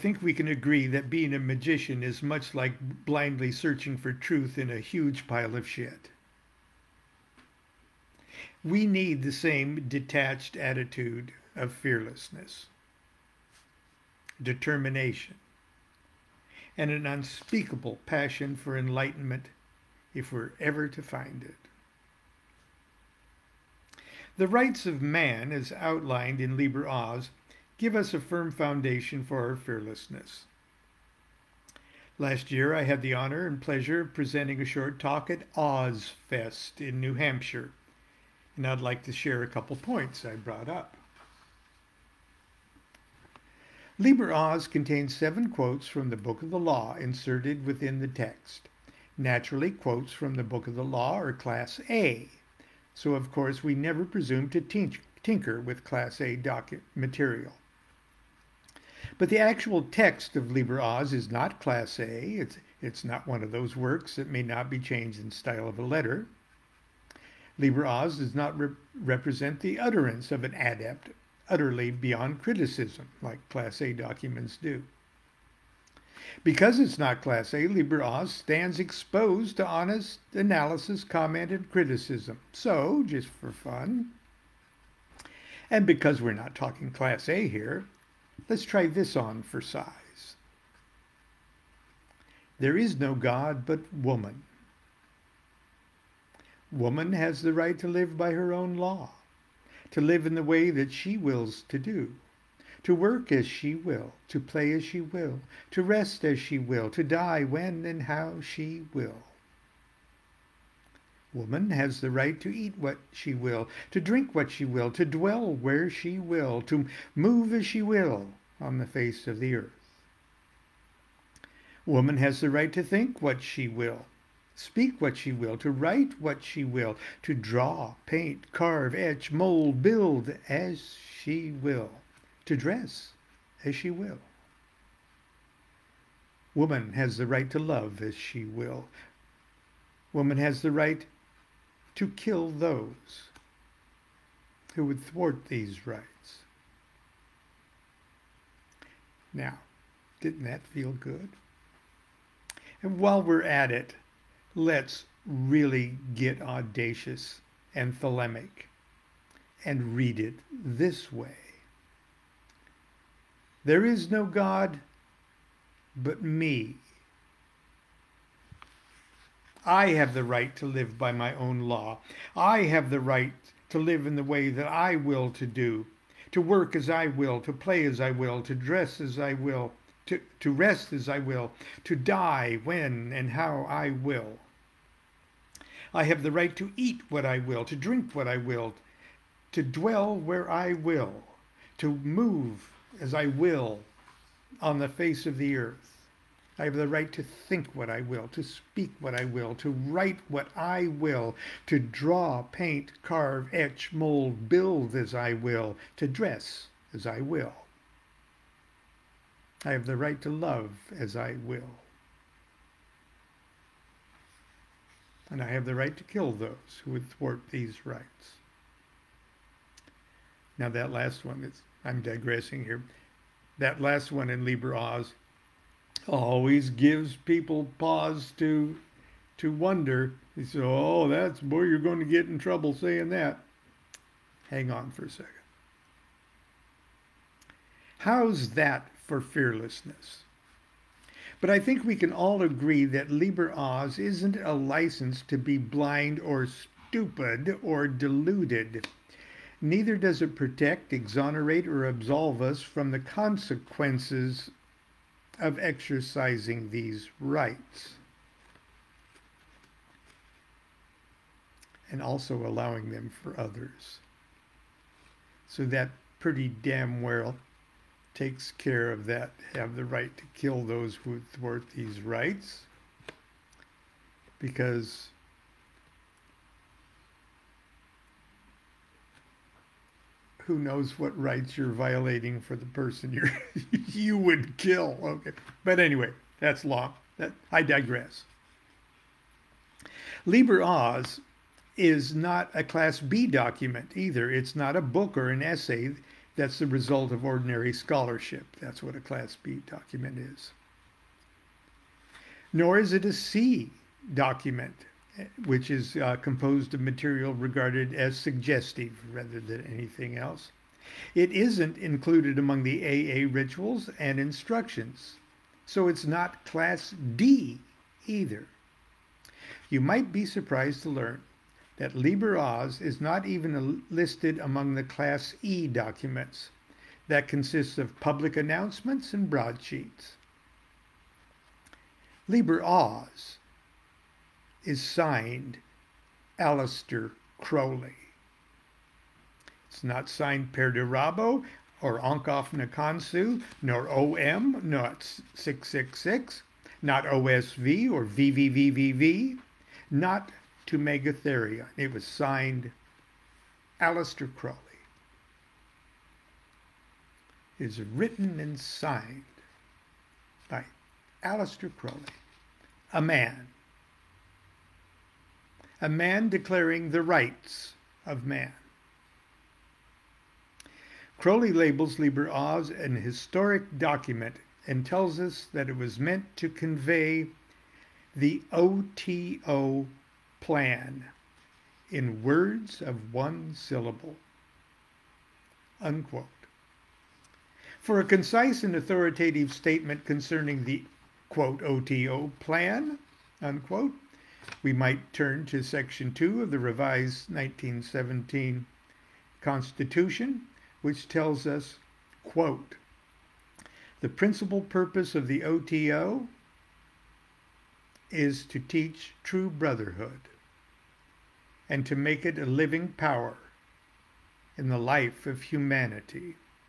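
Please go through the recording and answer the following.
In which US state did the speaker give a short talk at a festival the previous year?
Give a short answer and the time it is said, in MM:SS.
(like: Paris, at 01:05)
New Hampshire, at 00:37.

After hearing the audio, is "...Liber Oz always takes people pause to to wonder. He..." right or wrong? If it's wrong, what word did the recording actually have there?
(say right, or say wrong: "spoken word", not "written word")
wrong: "gives", not "takes".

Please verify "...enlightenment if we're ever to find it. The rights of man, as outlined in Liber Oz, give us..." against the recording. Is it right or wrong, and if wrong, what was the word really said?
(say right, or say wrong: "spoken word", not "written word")
right.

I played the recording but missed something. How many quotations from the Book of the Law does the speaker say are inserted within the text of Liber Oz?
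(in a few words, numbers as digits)
7.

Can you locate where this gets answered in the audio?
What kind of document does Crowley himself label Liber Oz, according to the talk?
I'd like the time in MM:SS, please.
06:12.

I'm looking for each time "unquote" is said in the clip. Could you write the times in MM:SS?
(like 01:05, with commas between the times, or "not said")
06:25, 06:33.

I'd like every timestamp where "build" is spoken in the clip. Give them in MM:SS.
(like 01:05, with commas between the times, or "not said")
02:09, 03:24.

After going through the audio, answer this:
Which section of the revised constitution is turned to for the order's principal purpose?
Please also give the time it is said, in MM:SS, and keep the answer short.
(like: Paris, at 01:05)
Section 2, at 06:35.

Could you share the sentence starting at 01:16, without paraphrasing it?
Because it's not Class A, Liber Oz stands exposed to honest analysis, comment, and criticism.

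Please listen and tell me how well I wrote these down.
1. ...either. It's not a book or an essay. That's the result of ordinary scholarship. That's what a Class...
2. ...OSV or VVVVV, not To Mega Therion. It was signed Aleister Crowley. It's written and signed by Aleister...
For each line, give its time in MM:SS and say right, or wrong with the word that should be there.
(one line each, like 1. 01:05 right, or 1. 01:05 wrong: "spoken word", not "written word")
1. 04:53 right
2. 05:47 right.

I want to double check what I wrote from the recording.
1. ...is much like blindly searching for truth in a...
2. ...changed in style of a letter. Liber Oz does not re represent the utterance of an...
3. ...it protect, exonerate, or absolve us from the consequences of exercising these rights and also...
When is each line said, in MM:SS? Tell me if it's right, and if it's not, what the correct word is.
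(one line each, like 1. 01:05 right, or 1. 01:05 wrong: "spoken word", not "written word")
1. 00:02 right
2. 01:04 right
3. 04:10 right.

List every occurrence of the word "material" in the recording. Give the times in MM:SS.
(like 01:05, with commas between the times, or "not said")
00:56, 05:06.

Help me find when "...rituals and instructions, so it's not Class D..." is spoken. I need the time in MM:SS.
05:13.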